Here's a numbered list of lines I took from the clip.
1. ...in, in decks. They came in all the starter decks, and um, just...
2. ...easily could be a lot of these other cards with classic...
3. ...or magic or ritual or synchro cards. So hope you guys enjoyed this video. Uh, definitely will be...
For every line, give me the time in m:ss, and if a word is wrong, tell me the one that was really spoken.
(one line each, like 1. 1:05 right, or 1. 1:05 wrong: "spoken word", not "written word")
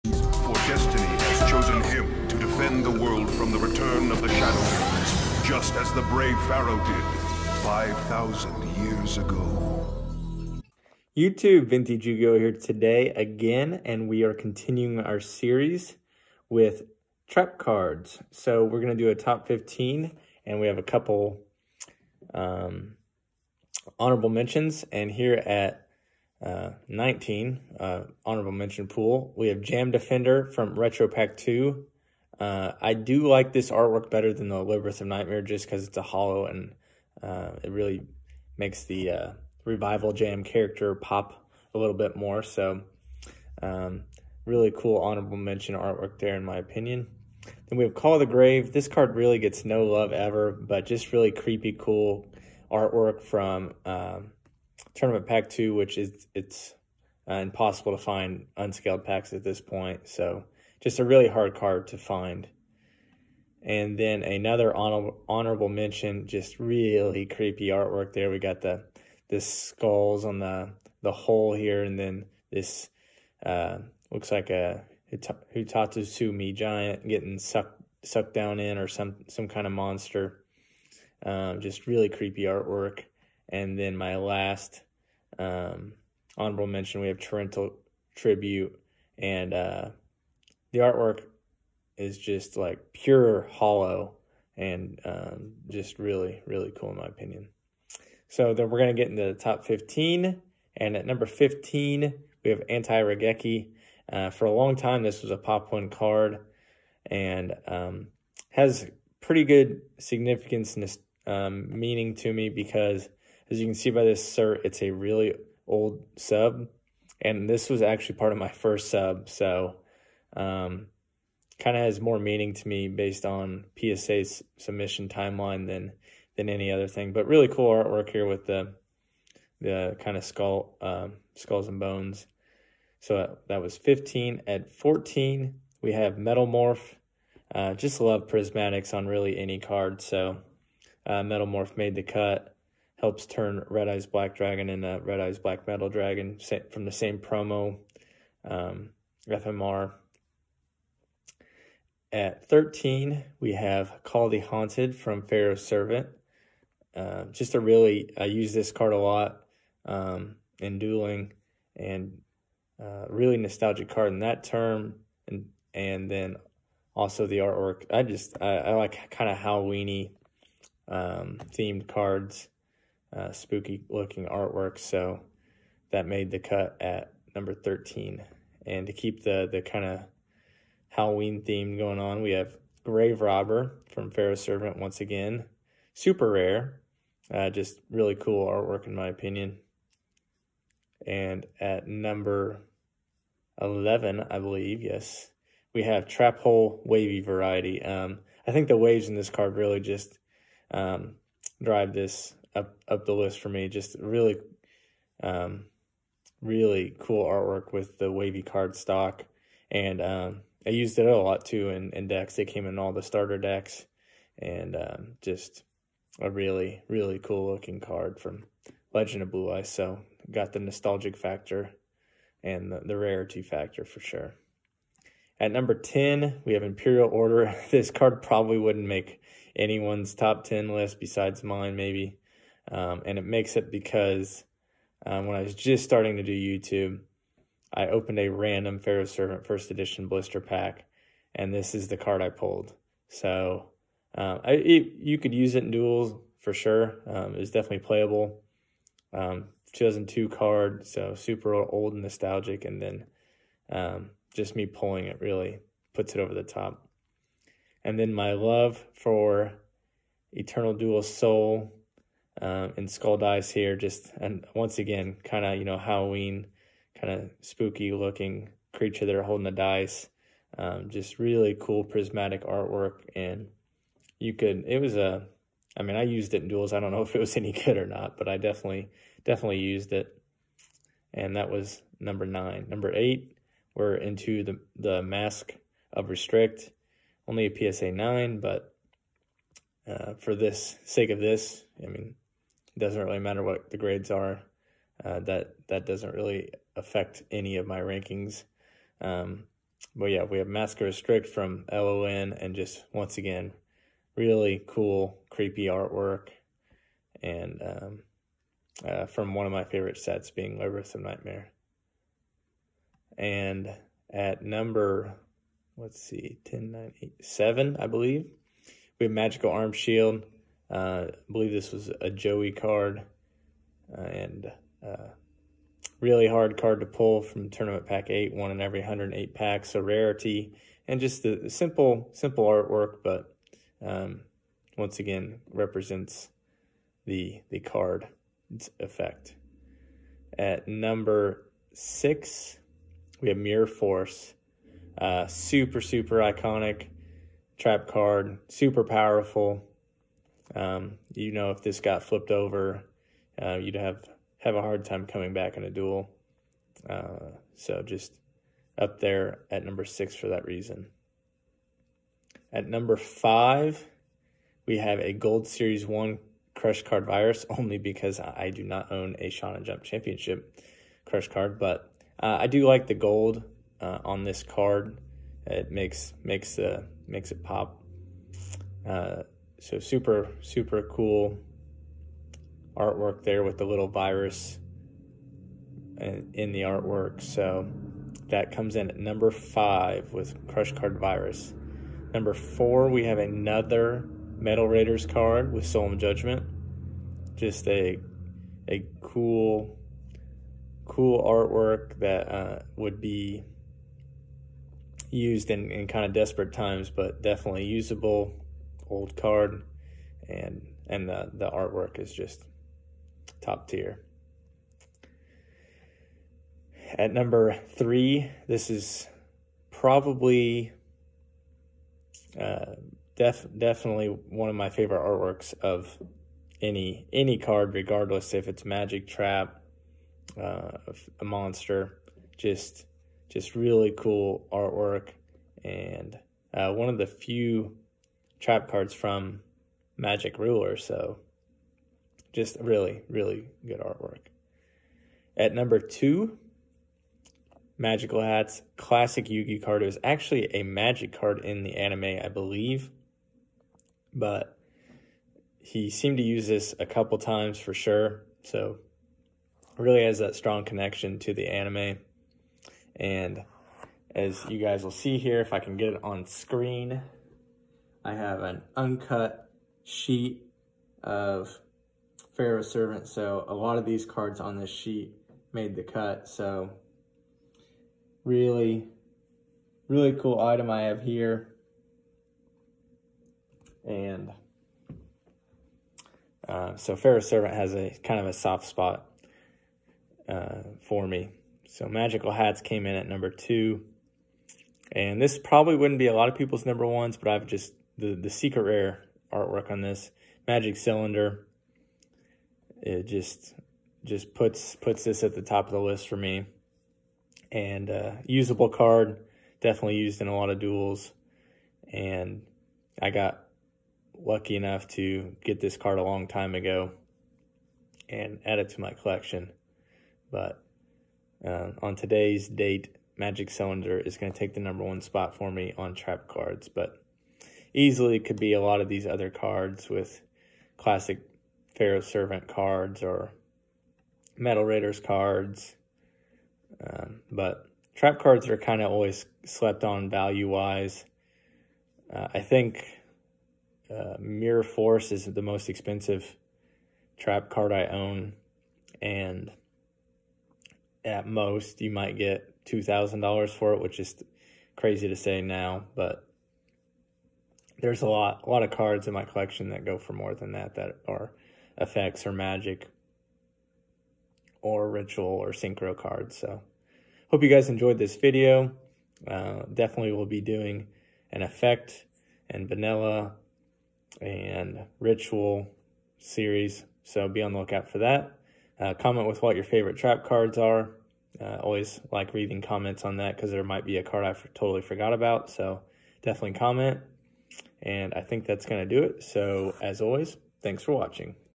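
1. 3:31 right
2. 8:47 right
3. 9:22 right.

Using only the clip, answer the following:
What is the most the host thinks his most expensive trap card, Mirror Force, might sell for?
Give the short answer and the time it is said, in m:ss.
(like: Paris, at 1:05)
$2,000, at 9:12.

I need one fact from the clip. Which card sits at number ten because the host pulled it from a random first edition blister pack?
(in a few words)
Imperial Order.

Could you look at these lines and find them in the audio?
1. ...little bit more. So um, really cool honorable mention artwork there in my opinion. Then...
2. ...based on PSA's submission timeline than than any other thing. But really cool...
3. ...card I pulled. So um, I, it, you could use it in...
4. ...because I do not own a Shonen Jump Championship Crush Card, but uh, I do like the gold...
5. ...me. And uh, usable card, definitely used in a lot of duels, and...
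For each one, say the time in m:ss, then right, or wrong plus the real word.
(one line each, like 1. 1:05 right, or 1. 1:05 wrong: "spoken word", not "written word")
1. 0:41 right
2. 2:02 right
3. 4:01 right
4. 6:07 right
5. 8:26 right.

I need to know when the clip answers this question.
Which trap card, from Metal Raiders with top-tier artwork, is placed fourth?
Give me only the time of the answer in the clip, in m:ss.
6:35.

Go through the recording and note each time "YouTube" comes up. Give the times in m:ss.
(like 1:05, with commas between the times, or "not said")
0:11, 3:56.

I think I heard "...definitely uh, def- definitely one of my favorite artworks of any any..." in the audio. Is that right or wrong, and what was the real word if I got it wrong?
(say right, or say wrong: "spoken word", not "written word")
wrong: "probably", not "definitely".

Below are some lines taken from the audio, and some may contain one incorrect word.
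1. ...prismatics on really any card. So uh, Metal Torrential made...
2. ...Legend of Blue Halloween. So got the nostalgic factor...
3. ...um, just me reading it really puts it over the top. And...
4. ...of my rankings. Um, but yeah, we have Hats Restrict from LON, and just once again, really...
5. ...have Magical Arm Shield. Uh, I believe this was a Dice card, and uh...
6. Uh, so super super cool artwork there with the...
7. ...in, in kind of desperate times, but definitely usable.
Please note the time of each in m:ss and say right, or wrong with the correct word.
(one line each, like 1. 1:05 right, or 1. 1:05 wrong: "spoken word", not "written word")
1. 2:18 wrong: "Morph", not "Torrential"
2. 3:38 wrong: "Eyes", not "Halloween"
3. 4:13 wrong: "pulling", not "reading"
4. 4:57 wrong: "Mask", not "Hats"
5. 5:19 wrong: "Joey", not "Dice"
6. 6:18 right
7. 6:45 right.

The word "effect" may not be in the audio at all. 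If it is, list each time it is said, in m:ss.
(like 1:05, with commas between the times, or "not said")
5:38, 9:21, 9:31.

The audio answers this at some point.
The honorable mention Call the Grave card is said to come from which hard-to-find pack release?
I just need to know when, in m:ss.
0:54.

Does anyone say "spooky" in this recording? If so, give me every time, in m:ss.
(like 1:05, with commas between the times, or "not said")
2:53, 4:27.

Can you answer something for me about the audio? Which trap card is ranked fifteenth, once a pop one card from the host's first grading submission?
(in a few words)
Anti-Raigeki.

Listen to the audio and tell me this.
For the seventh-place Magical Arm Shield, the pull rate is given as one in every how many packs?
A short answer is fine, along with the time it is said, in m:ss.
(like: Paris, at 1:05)
108, at 5:28.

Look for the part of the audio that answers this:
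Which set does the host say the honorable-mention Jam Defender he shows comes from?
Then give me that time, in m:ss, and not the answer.
0:30.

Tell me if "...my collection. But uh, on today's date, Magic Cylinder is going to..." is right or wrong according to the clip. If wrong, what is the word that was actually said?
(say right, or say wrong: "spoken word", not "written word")
right.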